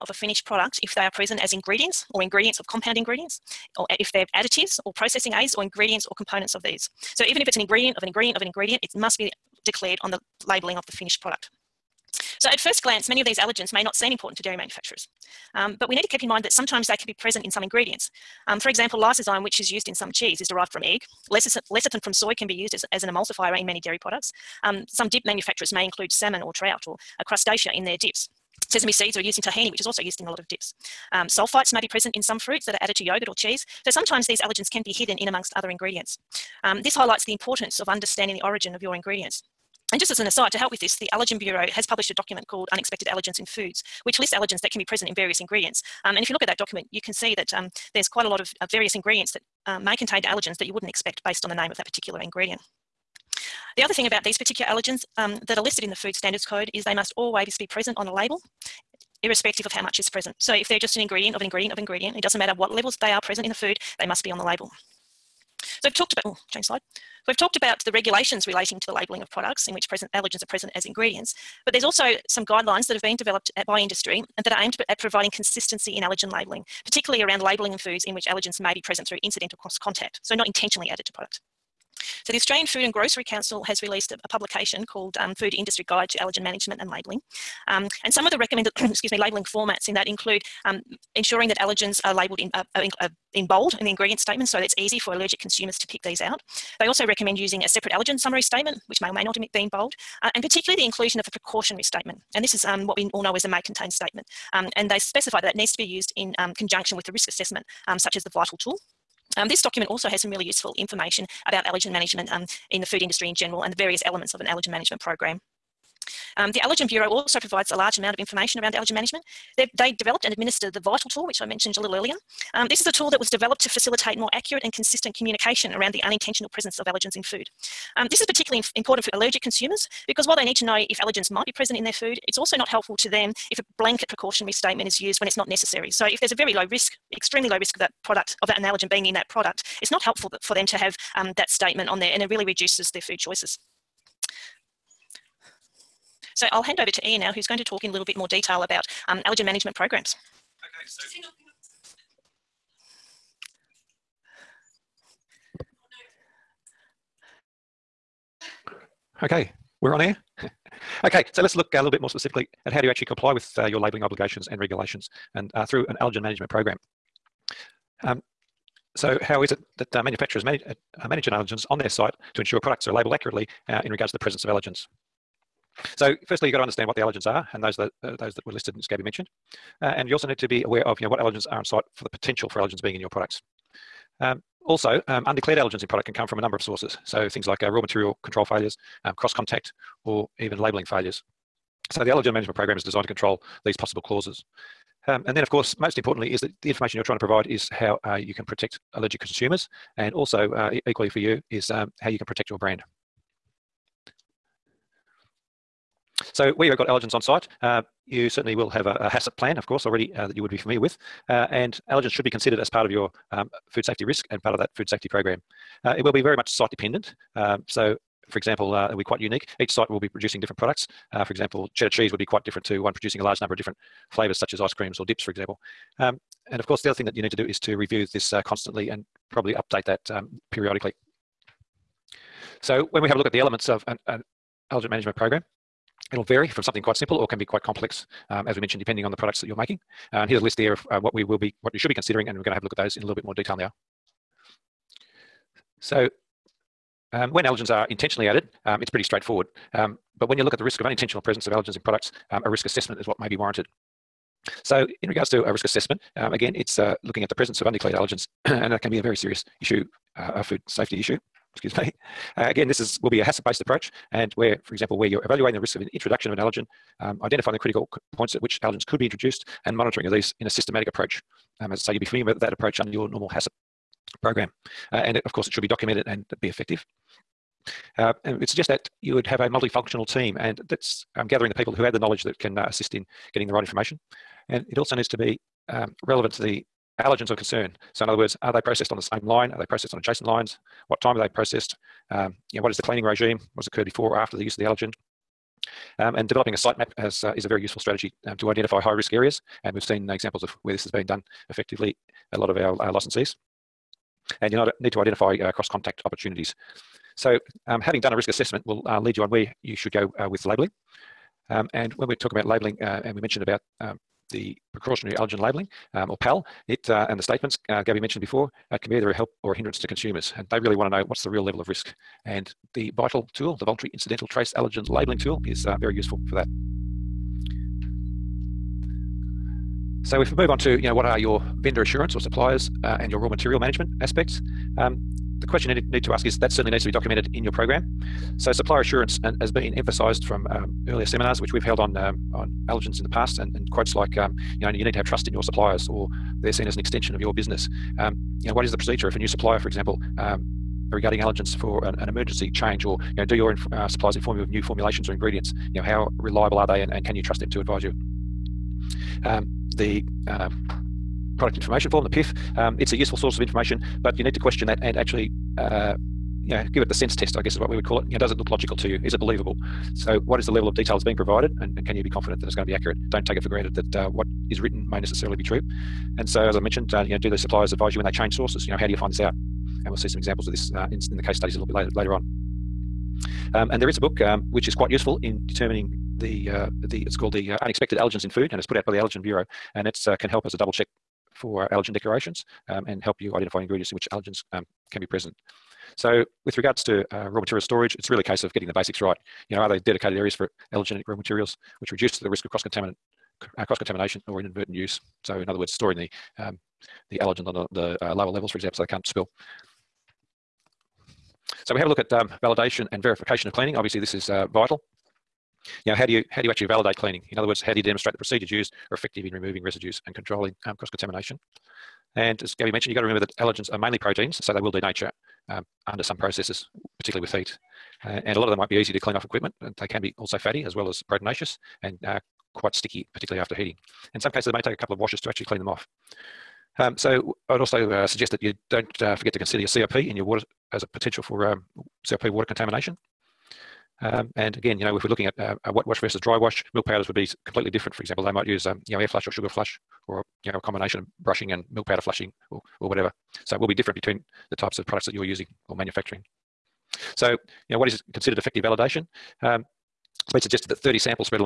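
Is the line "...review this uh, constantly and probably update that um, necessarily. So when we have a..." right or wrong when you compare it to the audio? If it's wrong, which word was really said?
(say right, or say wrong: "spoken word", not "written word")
wrong: "periodically", not "necessarily".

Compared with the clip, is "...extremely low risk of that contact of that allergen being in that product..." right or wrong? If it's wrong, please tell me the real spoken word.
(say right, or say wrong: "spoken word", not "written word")
wrong: "product", not "contact".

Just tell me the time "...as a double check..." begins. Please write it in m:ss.
6:30.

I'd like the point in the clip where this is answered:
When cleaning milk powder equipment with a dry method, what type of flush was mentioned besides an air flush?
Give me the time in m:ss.
7:29.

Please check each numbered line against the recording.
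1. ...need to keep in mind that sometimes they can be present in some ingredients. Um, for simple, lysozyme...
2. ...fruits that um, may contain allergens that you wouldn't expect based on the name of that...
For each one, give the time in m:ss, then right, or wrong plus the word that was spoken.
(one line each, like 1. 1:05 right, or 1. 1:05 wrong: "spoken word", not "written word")
1. 0:15 wrong: "example", not "simple"
2. 0:48 wrong: "ingredients", not "fruits".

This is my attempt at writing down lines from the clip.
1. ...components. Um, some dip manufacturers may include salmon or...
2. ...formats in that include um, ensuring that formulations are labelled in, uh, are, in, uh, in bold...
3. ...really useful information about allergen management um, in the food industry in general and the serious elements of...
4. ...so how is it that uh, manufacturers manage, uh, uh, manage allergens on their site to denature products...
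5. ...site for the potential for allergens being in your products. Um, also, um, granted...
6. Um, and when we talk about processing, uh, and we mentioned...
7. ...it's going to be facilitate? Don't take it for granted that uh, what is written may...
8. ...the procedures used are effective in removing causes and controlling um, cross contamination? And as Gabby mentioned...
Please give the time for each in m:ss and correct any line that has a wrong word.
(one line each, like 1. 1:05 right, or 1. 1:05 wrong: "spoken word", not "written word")
1. 0:23 wrong: "products", not "components"
2. 1:29 wrong: "allergens", not "formulations"
3. 1:50 wrong: "various", not "serious"
4. 2:48 wrong: "ensure", not "denature"
5. 3:01 wrong: "undeclared", not "granted"
6. 5:11 wrong: "labelling", not "processing"
7. 6:12 wrong: "accurate", not "facilitate"
8. 6:58 wrong: "residues", not "causes".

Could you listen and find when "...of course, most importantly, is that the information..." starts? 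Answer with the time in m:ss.
3:15.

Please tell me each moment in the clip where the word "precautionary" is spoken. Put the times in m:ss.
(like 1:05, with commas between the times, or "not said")
1:41, 2:14, 5:14.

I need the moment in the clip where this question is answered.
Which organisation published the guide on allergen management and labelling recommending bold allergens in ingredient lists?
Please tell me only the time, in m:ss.
1:22.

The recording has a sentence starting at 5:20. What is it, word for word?
And they really want to know what's the real level of risk.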